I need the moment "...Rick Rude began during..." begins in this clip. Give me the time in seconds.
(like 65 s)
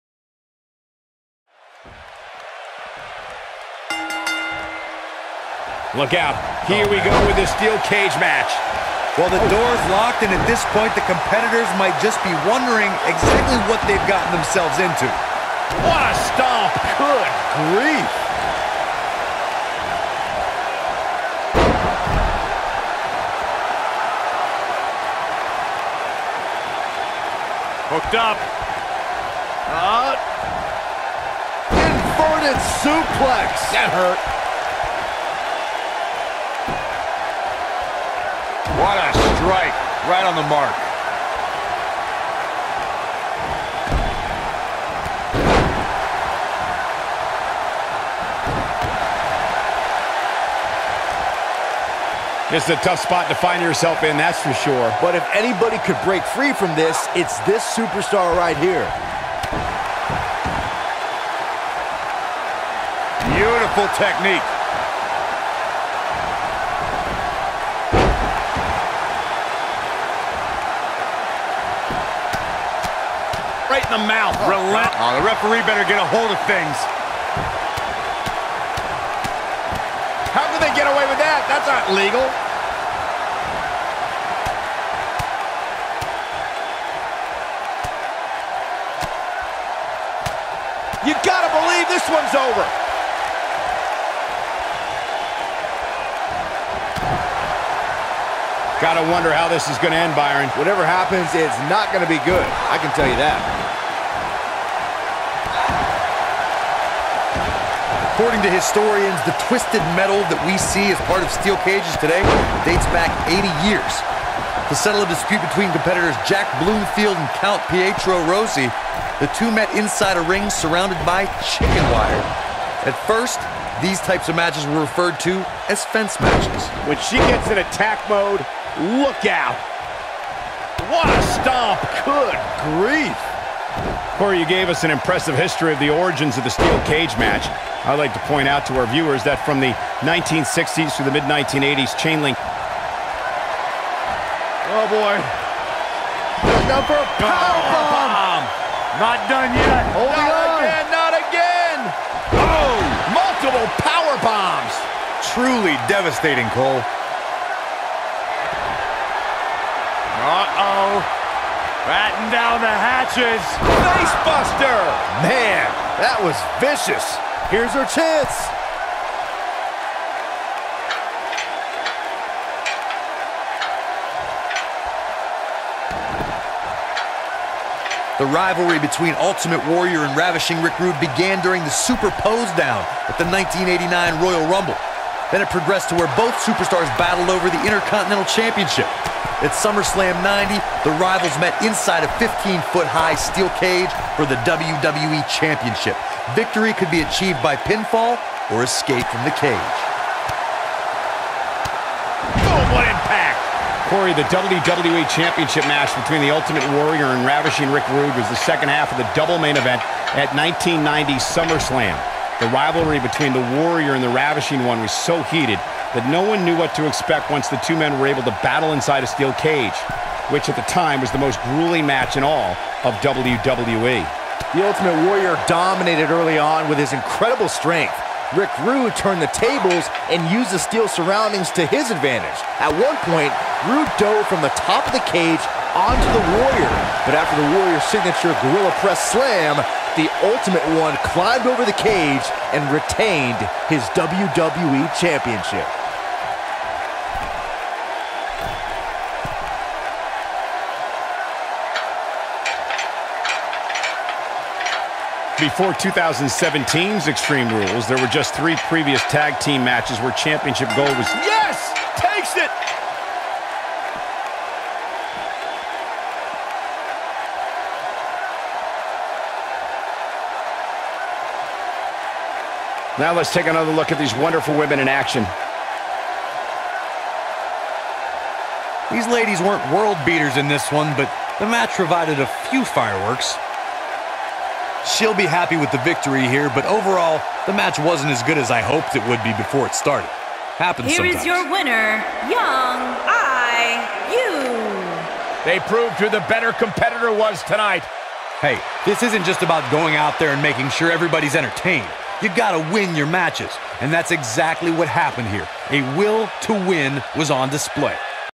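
180 s.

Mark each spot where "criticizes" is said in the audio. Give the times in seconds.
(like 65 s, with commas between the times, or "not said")
not said.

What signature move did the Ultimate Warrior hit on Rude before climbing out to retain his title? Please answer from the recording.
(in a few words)
Gorilla Press Slam.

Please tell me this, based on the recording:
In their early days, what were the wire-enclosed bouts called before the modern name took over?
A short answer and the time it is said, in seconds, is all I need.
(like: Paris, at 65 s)
fence matches, at 125 s.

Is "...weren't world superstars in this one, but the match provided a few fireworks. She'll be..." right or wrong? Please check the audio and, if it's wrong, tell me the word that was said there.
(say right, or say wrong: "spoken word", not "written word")
wrong: "beaters", not "superstars".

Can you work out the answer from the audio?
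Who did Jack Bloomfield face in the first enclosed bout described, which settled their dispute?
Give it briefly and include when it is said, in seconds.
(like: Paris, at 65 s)
Count Pietro Rossi, at 117 s.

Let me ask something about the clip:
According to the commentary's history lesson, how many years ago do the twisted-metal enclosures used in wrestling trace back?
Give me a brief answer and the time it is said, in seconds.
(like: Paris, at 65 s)
80 years, at 113 s.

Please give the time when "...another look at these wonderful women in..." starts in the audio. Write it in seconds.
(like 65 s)
273 s.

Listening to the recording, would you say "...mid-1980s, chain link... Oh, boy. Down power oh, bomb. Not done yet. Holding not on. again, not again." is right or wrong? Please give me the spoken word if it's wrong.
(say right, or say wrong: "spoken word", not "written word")
right.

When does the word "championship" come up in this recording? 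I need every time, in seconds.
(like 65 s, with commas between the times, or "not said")
188 s, 195 s, 205 s, 244 s, 260 s.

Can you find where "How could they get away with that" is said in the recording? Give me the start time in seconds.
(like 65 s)
80 s.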